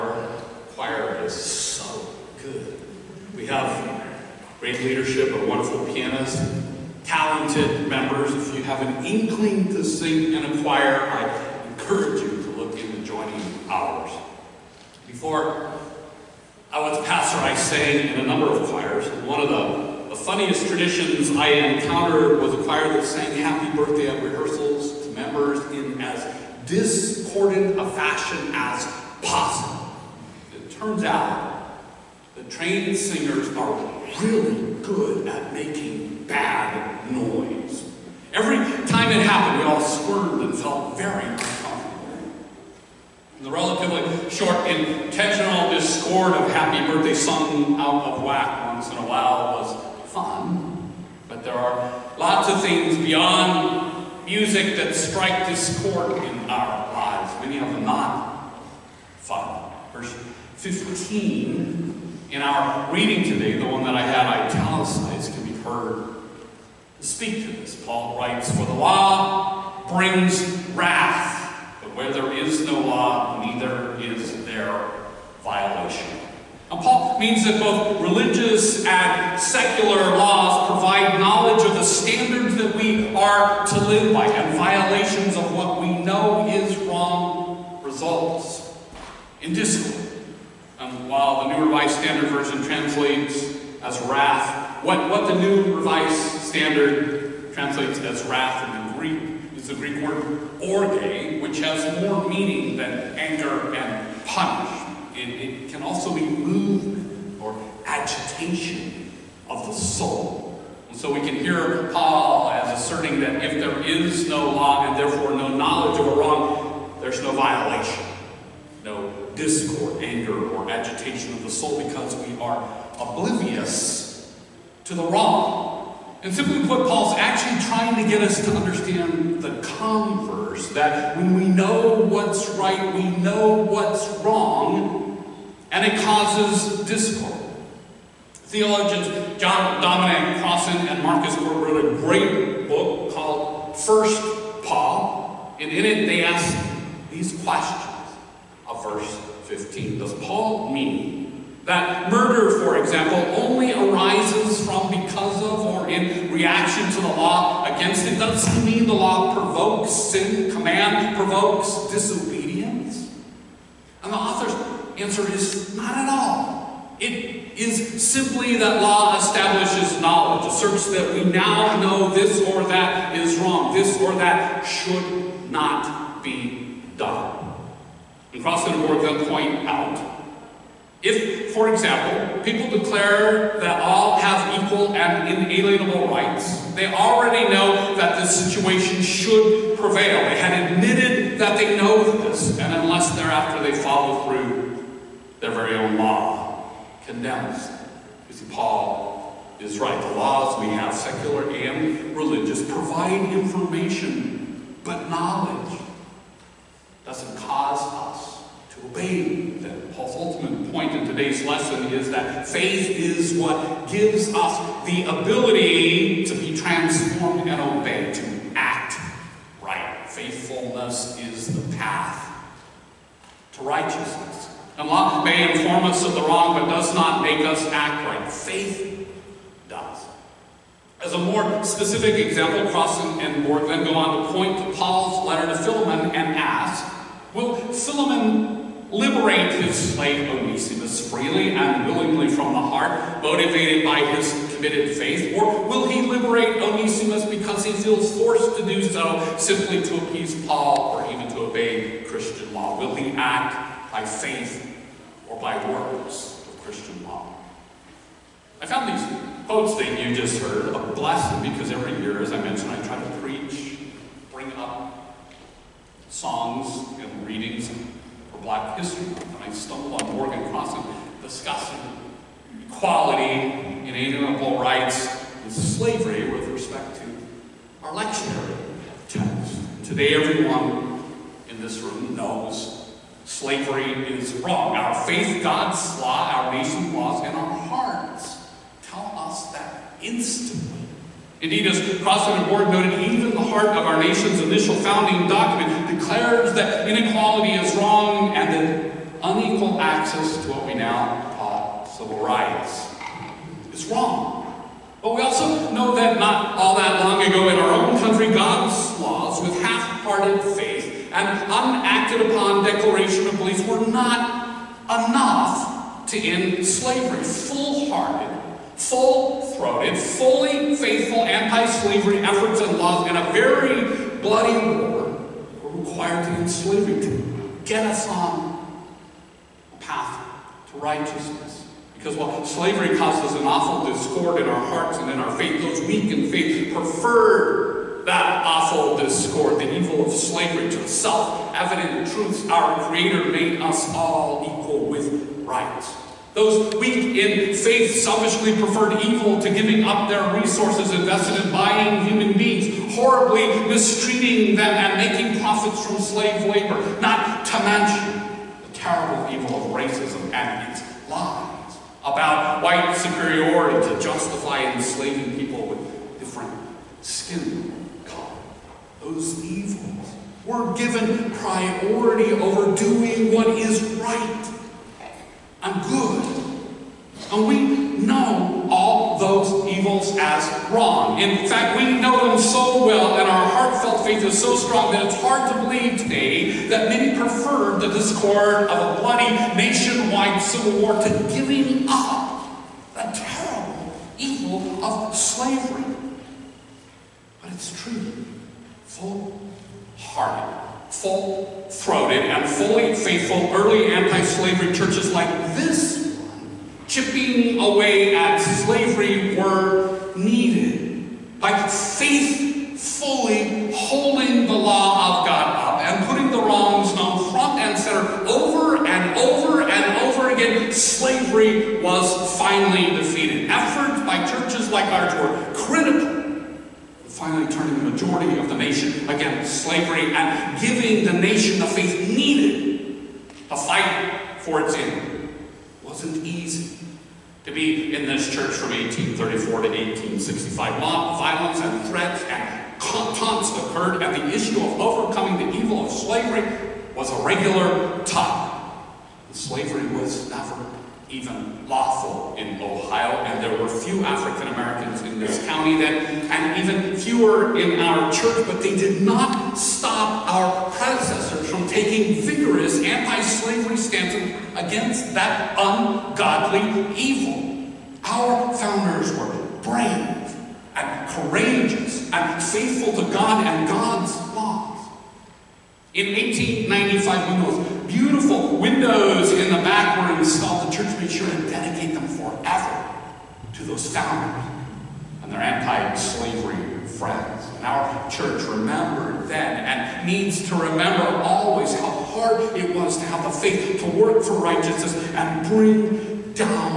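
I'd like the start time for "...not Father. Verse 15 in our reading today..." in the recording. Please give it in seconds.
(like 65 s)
57 s.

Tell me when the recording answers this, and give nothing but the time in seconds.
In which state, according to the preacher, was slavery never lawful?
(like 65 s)
452 s.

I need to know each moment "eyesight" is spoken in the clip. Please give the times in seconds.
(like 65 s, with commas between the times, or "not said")
not said.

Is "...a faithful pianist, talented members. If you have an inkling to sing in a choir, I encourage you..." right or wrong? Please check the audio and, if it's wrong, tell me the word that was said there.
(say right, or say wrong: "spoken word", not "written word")
wrong: "wonderful", not "faithful".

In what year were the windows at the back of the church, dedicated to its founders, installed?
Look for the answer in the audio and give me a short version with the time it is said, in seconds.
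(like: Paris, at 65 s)
1895, at 476 s.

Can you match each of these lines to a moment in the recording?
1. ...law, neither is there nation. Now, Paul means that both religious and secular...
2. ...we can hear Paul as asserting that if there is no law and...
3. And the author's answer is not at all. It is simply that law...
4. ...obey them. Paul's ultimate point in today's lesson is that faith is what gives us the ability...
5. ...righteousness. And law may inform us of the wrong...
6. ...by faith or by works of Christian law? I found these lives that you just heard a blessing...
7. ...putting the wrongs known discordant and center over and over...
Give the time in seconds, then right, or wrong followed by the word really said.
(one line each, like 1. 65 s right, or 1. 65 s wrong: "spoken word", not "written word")
1. 72 s wrong: "violation", not "nation"
2. 111 s right
3. 164 s right
4. 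208 s right
5. 223 s right
6. 253 s wrong: "quotes", not "lives"
7. 416 s wrong: "front", not "discordant".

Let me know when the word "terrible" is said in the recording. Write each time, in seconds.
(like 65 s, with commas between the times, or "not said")
358 s, 393 s.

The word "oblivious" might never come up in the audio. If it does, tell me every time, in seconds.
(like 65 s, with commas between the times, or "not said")
122 s.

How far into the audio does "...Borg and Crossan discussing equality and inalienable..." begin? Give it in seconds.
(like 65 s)
270 s.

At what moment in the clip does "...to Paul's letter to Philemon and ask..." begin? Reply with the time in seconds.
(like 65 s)
234 s.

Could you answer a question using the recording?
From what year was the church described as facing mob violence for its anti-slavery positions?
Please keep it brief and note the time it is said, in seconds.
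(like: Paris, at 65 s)
1834, at 438 s.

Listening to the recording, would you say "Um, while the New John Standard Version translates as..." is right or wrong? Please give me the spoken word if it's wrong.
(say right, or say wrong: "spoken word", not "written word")
wrong: "Revised", not "John".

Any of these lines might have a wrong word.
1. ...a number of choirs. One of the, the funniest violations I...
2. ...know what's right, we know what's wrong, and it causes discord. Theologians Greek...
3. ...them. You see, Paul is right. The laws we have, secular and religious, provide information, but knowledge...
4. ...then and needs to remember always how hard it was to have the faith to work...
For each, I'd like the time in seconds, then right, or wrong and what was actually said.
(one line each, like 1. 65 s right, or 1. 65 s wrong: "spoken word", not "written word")
1. 18 s wrong: "traditions", not "violations"
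2. 131 s wrong: "John", not "Greek"
3. 197 s right
4. 489 s right.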